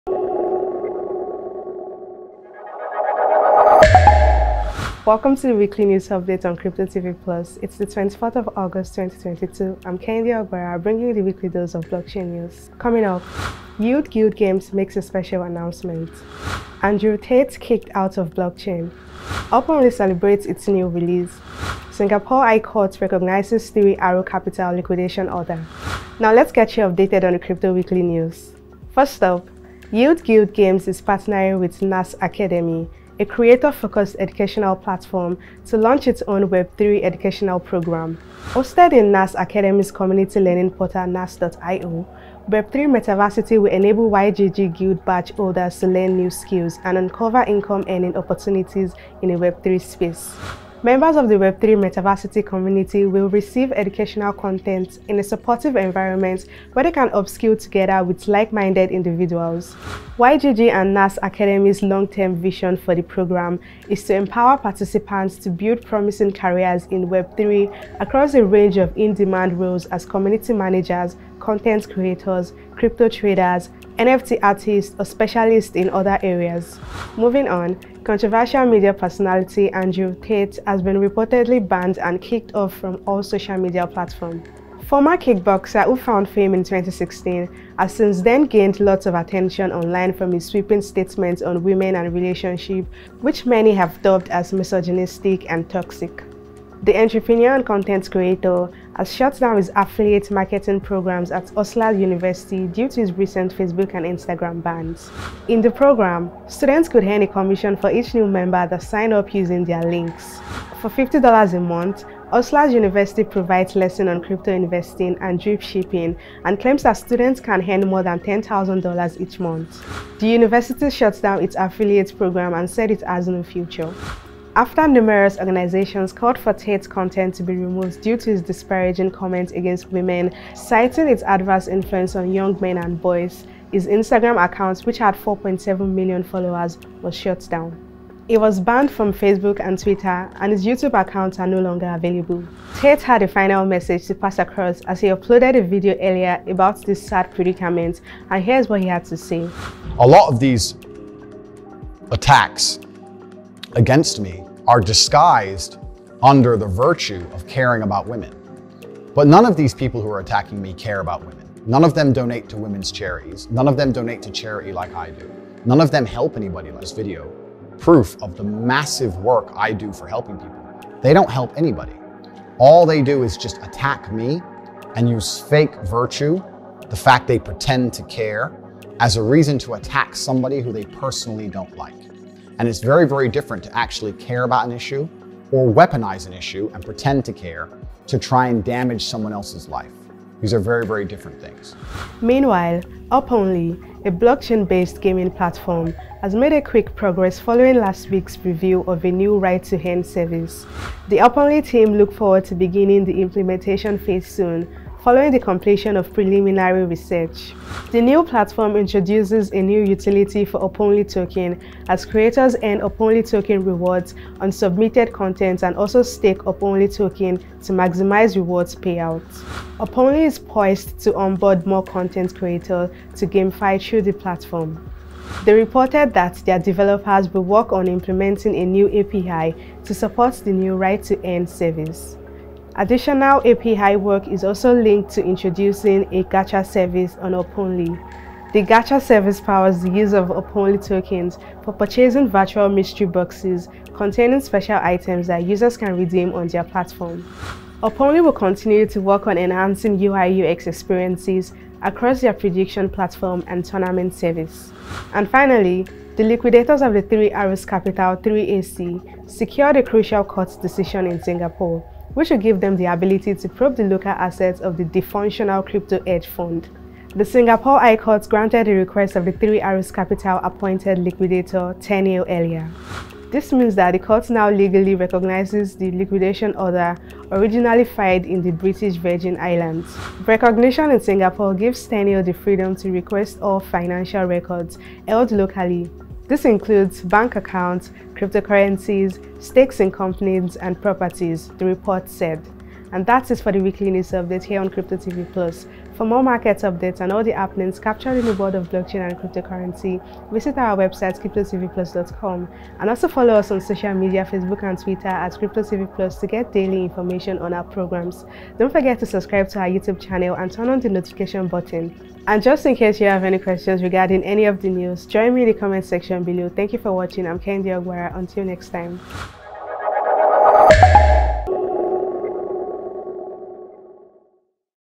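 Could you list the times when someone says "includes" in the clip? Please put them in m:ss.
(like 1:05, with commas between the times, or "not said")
4:46.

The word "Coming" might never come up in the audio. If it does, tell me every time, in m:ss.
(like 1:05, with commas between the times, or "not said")
0:12.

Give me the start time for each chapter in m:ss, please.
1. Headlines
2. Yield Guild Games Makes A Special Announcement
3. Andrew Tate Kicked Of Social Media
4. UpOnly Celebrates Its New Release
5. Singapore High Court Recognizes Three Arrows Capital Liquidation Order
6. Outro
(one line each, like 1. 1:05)
1. 0:15
2. 0:35
3. 1:32
4. 2:28
5. 3:28
6. 4:11.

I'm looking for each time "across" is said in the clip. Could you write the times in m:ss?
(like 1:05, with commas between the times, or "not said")
1:08, 2:24, 4:11.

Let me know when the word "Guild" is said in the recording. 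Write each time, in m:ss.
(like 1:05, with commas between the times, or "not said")
0:14, 0:30, 0:44.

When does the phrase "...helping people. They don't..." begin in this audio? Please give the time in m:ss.
2:50.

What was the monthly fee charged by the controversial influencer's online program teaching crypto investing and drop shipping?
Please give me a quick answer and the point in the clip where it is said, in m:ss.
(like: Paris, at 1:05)
$50, at 1:50.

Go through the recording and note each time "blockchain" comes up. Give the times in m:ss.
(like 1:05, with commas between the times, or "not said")
0:11, 0:18, 3:14, 4:58.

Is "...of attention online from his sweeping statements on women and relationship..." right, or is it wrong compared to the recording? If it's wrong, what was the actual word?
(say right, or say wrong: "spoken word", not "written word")
right.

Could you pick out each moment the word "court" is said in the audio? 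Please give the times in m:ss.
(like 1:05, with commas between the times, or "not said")
0:22, 4:20, 4:27, 4:33.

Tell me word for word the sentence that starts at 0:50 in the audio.
Members of the Web3 Metaversity community will receive educational content in a supportive environment where they can upskill together with like-minded individuals.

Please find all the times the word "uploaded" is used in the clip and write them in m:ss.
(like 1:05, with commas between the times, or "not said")
2:25.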